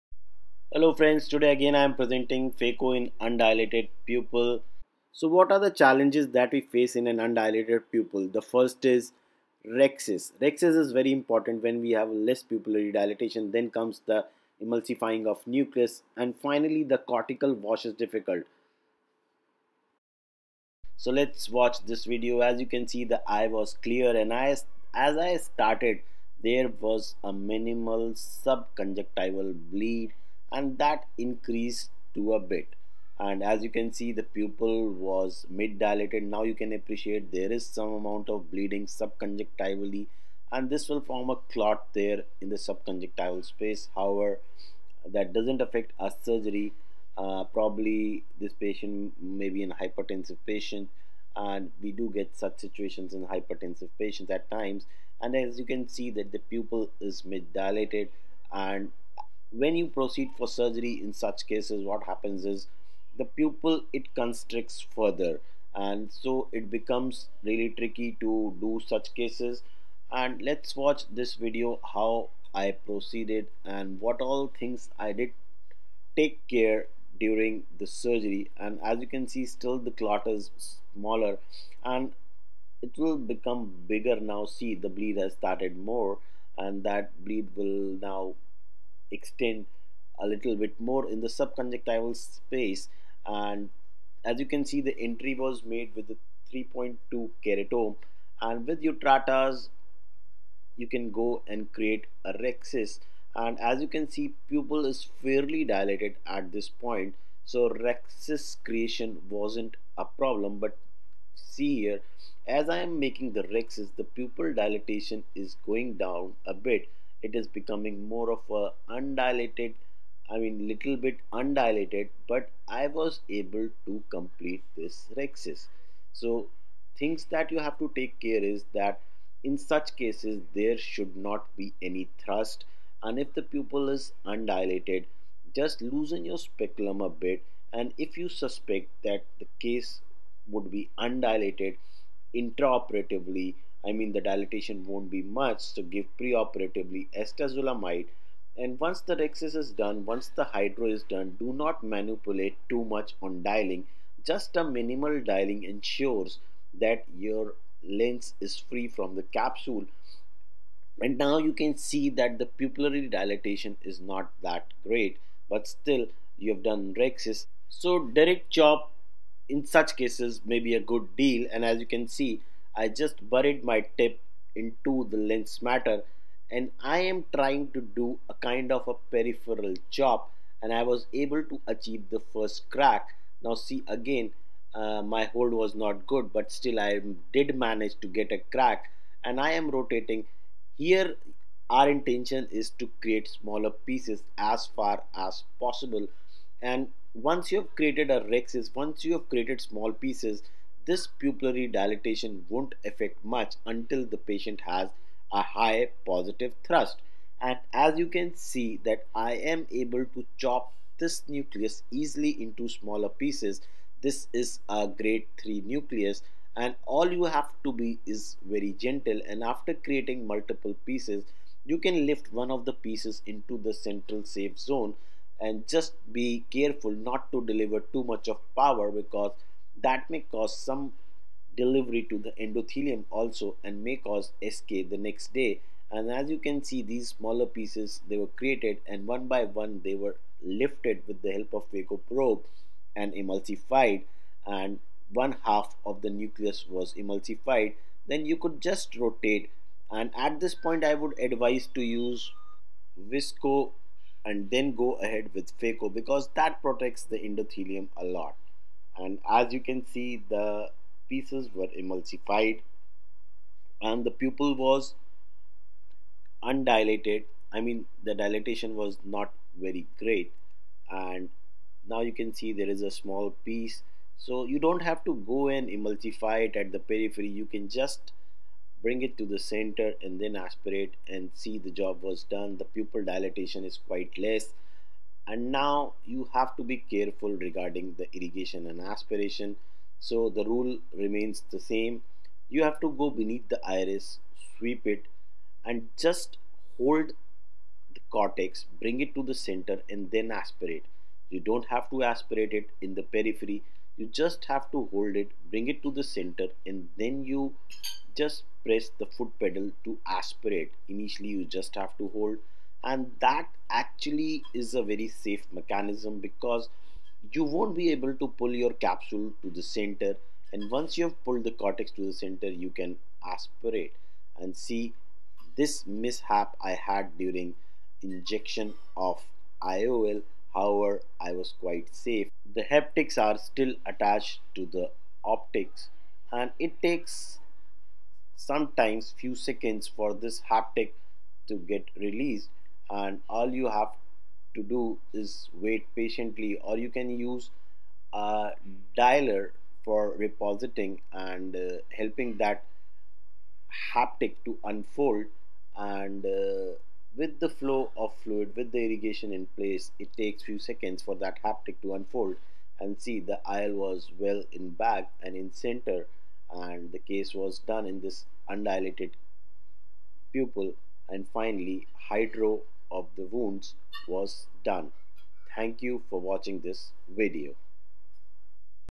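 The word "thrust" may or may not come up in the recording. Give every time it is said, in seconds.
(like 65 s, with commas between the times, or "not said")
132 s, 206 s.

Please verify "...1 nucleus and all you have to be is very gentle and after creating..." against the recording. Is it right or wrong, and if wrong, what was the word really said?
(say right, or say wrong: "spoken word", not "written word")
wrong: "3", not "1".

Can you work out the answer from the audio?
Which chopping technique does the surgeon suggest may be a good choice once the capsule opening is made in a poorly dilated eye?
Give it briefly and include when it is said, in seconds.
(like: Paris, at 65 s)
direct chop, at 168 s.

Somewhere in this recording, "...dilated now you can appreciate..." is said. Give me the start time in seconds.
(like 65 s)
35 s.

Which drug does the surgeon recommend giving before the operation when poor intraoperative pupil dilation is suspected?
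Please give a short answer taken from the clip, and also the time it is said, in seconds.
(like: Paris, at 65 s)
acetazolamide, at 147 s.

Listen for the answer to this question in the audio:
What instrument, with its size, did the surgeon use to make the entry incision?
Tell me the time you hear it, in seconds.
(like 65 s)
96 s.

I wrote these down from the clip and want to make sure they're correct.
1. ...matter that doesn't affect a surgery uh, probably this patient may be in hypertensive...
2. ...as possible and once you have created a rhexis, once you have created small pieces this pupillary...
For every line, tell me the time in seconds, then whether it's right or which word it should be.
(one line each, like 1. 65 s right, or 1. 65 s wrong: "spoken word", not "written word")
1. 43 s wrong: "however", not "matter"
2. 195 s right.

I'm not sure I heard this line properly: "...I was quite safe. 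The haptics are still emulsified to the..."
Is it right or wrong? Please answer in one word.
wrong.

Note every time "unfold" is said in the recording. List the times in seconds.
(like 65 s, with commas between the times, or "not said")
354 s, 361 s.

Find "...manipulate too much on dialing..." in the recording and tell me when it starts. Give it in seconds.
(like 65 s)
151 s.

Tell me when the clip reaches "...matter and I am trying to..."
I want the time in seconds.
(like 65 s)
175 s.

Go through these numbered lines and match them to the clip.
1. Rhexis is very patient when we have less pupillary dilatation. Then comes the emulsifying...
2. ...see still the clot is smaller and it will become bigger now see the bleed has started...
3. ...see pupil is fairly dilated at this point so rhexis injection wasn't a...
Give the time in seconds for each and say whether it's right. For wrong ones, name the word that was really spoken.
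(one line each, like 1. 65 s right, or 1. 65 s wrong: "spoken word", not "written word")
1. 10 s wrong: "important", not "patient"
2. 79 s right
3. 104 s wrong: "creation", not "injection".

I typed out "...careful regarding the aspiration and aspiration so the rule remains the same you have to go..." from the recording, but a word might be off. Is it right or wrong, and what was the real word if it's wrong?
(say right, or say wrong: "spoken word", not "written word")
wrong: "irrigation", not "aspiration".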